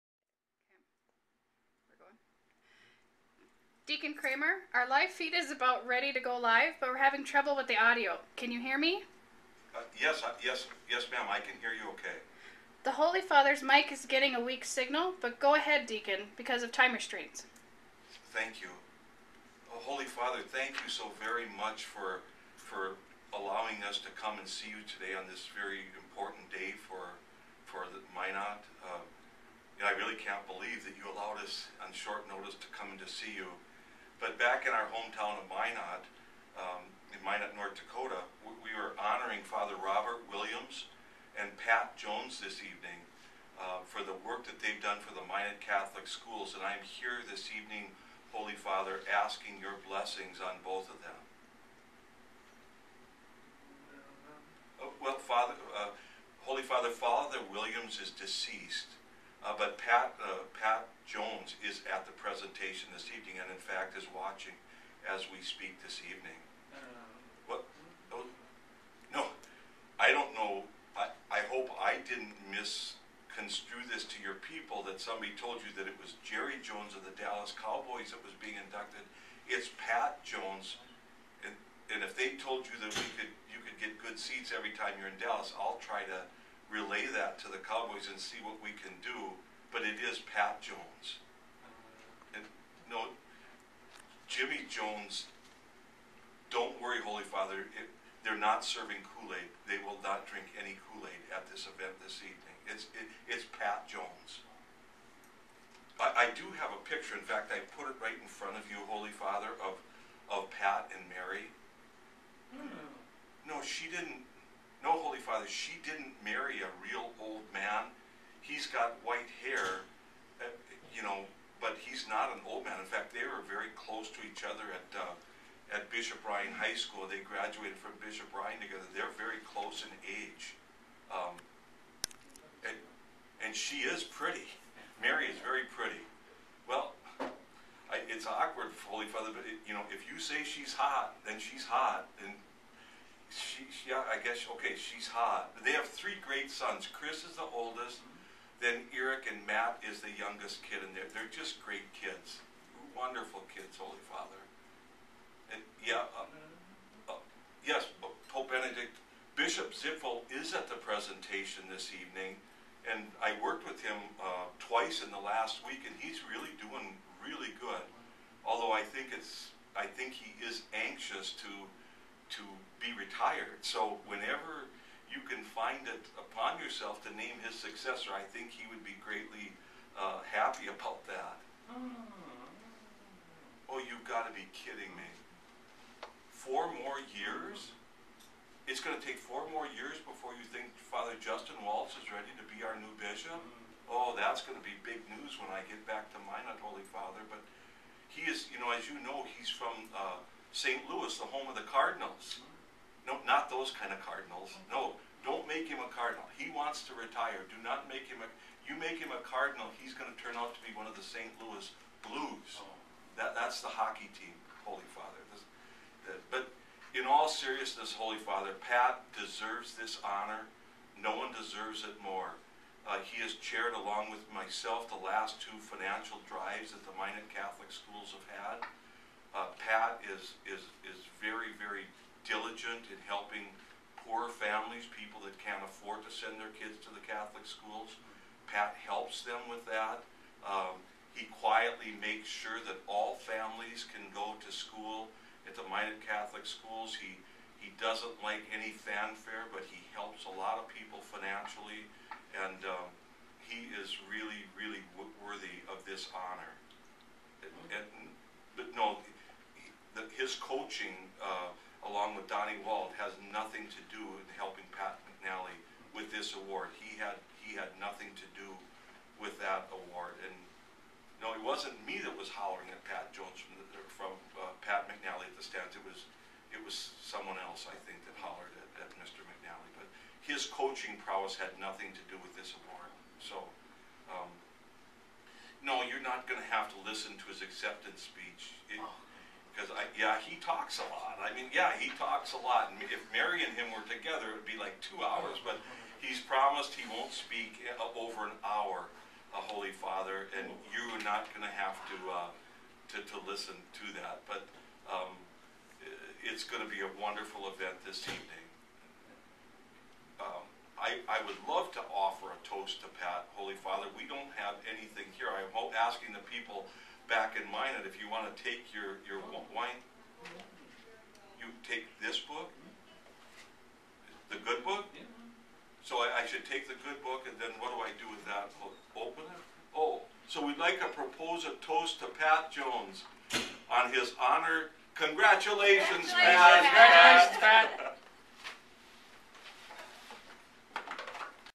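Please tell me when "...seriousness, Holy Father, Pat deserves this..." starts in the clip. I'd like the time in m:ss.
3:37.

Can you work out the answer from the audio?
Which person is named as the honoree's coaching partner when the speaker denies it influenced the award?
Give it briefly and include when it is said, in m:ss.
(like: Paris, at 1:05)
Donnie Wald, at 4:22.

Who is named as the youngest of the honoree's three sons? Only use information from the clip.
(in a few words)
Matt.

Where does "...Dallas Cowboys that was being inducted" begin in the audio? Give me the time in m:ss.
1:17.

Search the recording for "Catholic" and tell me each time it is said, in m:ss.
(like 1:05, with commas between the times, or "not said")
0:45, 3:47, 3:57, 4:06.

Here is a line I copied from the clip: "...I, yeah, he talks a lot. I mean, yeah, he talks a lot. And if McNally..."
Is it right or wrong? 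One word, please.
wrong.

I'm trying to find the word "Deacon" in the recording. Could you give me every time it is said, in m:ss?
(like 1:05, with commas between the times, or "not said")
0:03, 0:15.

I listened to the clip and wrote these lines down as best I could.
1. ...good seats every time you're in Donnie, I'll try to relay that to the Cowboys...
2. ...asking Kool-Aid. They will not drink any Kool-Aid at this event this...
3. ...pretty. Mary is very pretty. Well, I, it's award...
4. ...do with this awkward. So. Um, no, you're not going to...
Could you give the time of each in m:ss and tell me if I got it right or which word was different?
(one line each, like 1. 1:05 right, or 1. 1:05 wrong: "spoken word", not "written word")
1. 1:23 wrong: "Dallas", not "Donnie"
2. 1:38 wrong: "serving", not "asking"
3. 2:14 wrong: "awkward", not "award"
4. 4:42 wrong: "award", not "awkward".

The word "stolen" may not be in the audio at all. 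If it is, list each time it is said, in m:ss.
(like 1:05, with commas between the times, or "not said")
not said.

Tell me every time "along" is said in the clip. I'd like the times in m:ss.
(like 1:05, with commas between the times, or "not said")
3:43, 4:21.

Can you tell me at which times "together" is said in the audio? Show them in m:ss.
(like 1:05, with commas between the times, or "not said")
2:08, 4:53.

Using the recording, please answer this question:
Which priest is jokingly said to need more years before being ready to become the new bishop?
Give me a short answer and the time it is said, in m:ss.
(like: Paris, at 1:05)
Father Justin Waltz, at 3:10.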